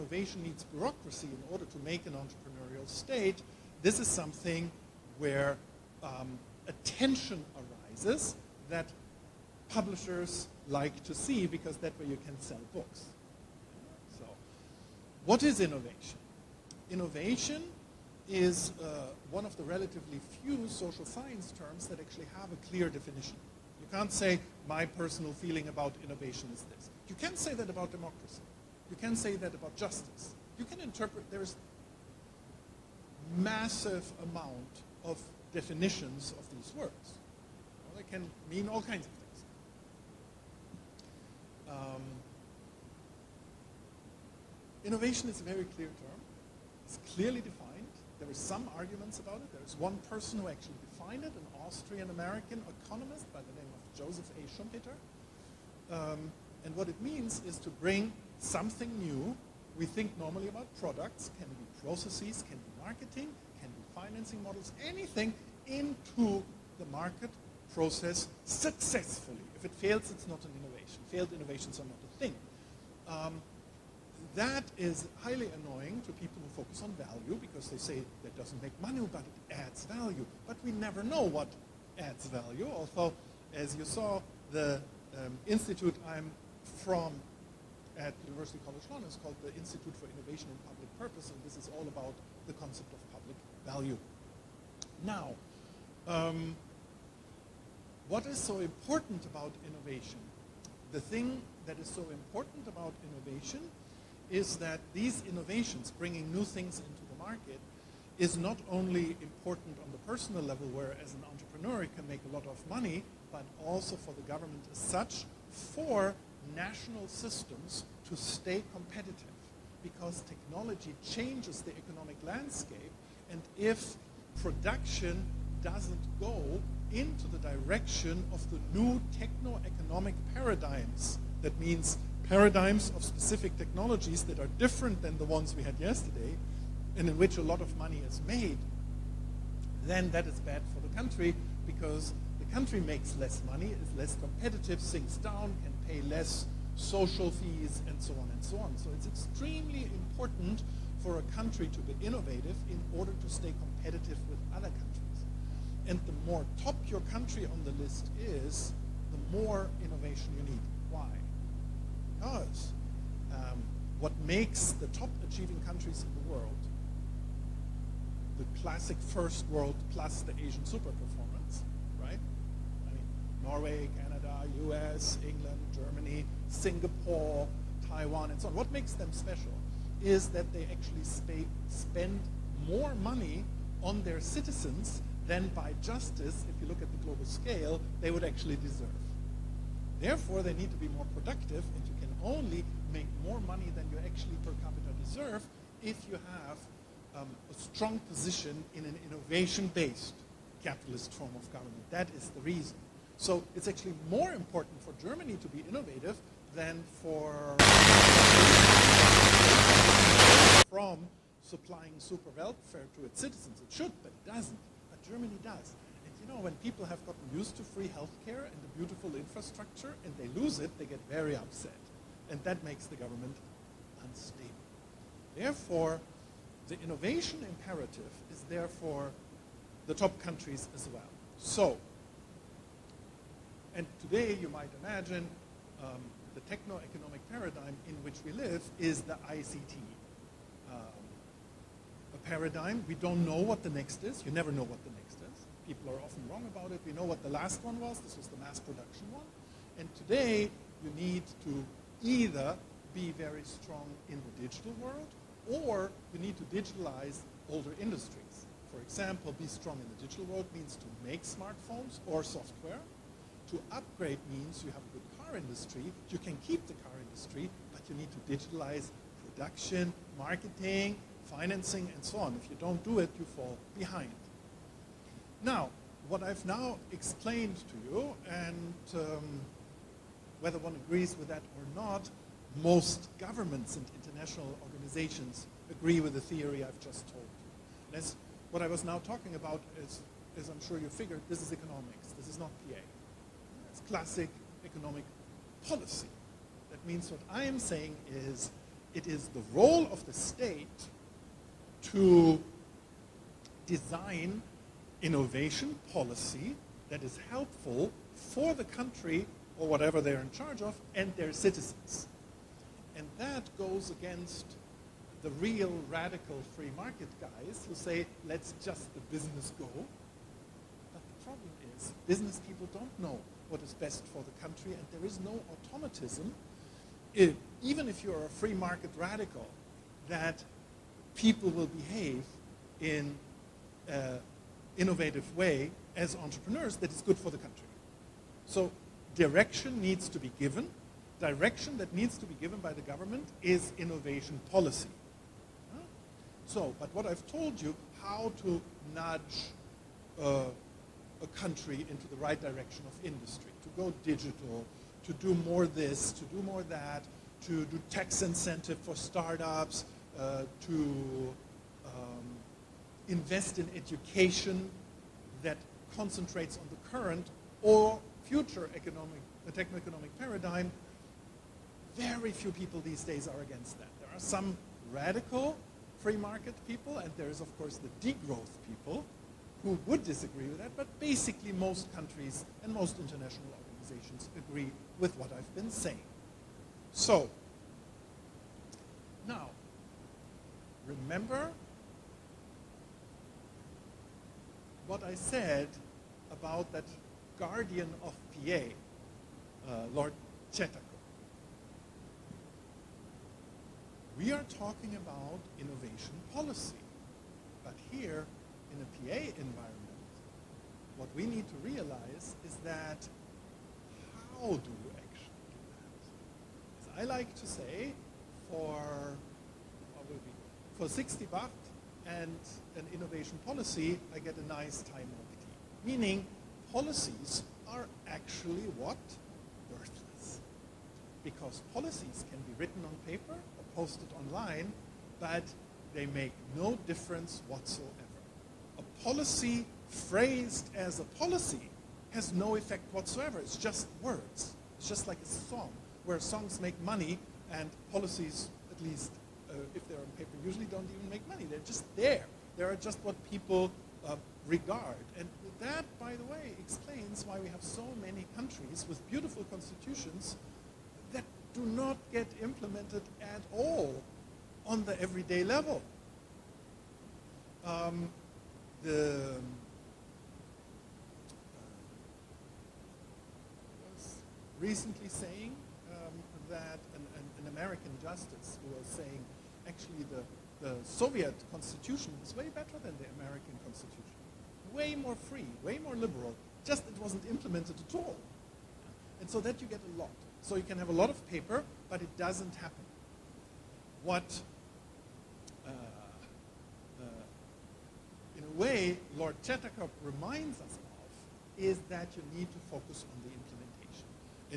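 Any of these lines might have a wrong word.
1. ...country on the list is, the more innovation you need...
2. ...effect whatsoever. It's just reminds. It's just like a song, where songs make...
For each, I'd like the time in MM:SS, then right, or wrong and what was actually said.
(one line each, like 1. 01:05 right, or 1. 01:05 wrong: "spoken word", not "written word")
1. 02:37 right
2. 07:22 wrong: "words", not "reminds".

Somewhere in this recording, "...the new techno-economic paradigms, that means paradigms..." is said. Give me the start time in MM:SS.
02:08.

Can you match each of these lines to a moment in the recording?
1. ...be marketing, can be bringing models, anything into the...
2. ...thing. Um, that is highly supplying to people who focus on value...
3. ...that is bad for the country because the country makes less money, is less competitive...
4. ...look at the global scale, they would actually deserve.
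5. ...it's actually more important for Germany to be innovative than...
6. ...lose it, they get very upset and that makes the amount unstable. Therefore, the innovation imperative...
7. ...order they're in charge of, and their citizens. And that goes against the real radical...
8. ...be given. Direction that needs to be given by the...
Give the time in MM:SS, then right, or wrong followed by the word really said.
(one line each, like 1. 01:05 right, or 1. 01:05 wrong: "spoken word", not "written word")
1. 01:02 wrong: "financing", not "bringing"
2. 01:12 wrong: "annoying", not "supplying"
3. 02:20 right
4. 03:06 right
5. 03:23 right
6. 03:40 wrong: "government", not "amount"
7. 05:09 wrong: "whatever", not "order"
8. 05:40 right.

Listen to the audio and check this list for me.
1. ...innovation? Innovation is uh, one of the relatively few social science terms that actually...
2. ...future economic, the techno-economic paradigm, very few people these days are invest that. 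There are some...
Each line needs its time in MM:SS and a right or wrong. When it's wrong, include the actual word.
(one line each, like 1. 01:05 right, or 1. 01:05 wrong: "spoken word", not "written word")
1. 00:15 right
2. 06:08 wrong: "against", not "invest".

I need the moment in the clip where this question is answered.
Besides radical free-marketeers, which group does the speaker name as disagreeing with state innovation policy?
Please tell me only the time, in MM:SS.
06:18.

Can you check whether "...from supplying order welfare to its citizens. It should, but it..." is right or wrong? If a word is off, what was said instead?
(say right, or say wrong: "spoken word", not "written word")
wrong: "super", not "order".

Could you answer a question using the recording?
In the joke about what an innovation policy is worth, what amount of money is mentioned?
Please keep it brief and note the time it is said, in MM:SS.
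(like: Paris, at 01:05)
60 baht, at 07:00.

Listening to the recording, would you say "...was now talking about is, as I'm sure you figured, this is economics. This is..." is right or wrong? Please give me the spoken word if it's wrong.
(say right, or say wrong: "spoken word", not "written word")
right.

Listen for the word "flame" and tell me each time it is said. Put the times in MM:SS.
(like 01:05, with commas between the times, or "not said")
not said.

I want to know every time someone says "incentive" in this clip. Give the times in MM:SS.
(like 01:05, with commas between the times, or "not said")
05:58.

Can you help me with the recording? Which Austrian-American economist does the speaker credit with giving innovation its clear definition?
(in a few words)
Joseph A. Schumpeter.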